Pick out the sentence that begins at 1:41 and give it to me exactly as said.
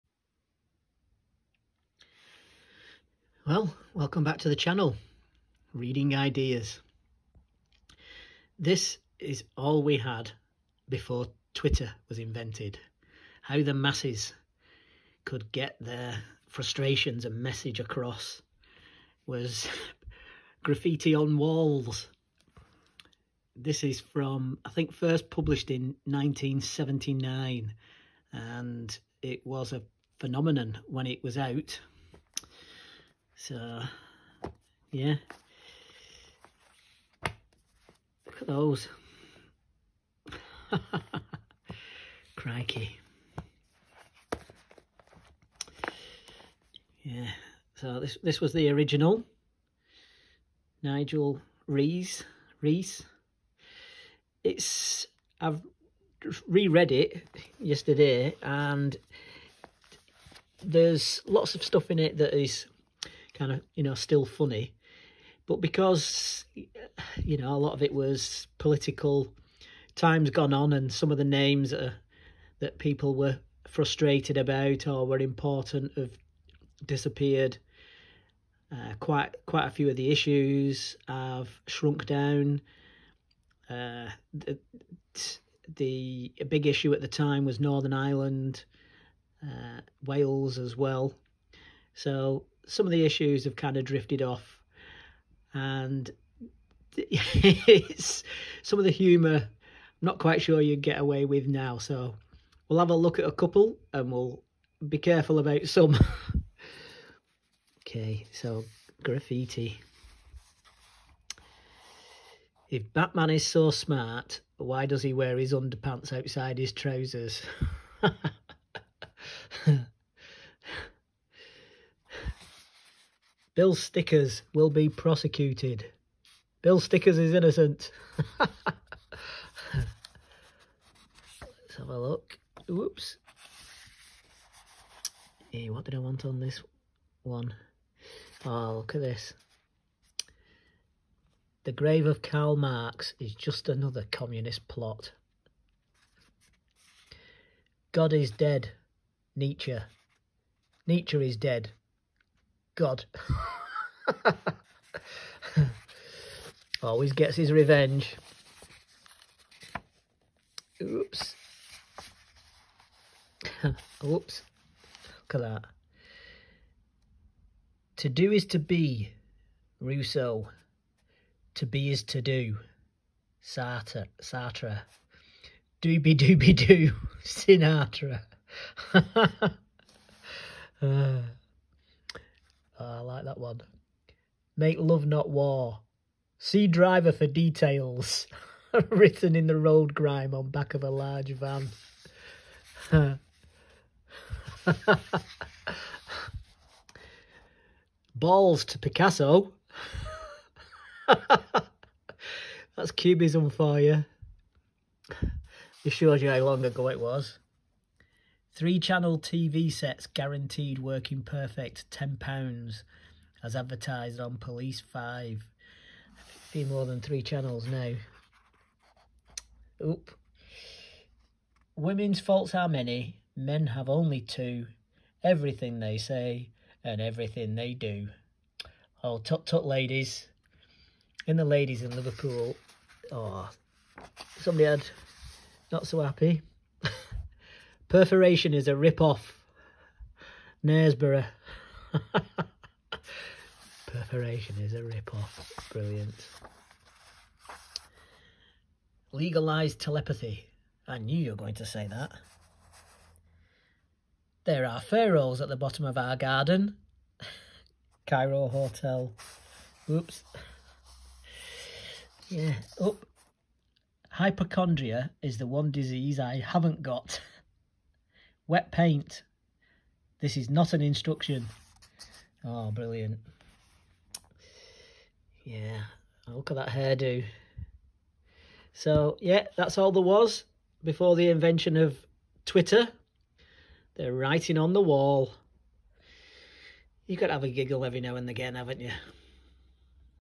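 So we'll have a look at a couple and we'll be careful about some.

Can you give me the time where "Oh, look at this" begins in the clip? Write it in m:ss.
2:18.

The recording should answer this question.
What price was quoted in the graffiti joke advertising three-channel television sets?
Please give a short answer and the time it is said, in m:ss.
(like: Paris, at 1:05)
£10, at 3:31.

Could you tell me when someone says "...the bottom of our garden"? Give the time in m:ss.
4:15.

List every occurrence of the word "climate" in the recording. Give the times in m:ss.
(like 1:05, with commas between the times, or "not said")
not said.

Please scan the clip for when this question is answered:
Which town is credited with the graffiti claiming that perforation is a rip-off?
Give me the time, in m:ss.
4:00.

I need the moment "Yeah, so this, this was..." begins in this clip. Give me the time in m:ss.
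0:47.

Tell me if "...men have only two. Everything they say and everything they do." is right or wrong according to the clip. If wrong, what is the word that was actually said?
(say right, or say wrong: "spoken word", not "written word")
right.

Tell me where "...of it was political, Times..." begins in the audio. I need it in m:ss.
1:07.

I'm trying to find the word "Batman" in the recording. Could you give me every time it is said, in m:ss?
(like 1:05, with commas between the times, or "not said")
1:52.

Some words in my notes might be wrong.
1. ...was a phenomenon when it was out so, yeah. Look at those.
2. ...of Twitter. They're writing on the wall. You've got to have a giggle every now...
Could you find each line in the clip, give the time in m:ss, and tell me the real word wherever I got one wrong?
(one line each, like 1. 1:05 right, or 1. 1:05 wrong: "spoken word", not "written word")
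1. 0:29 right
2. 4:41 right.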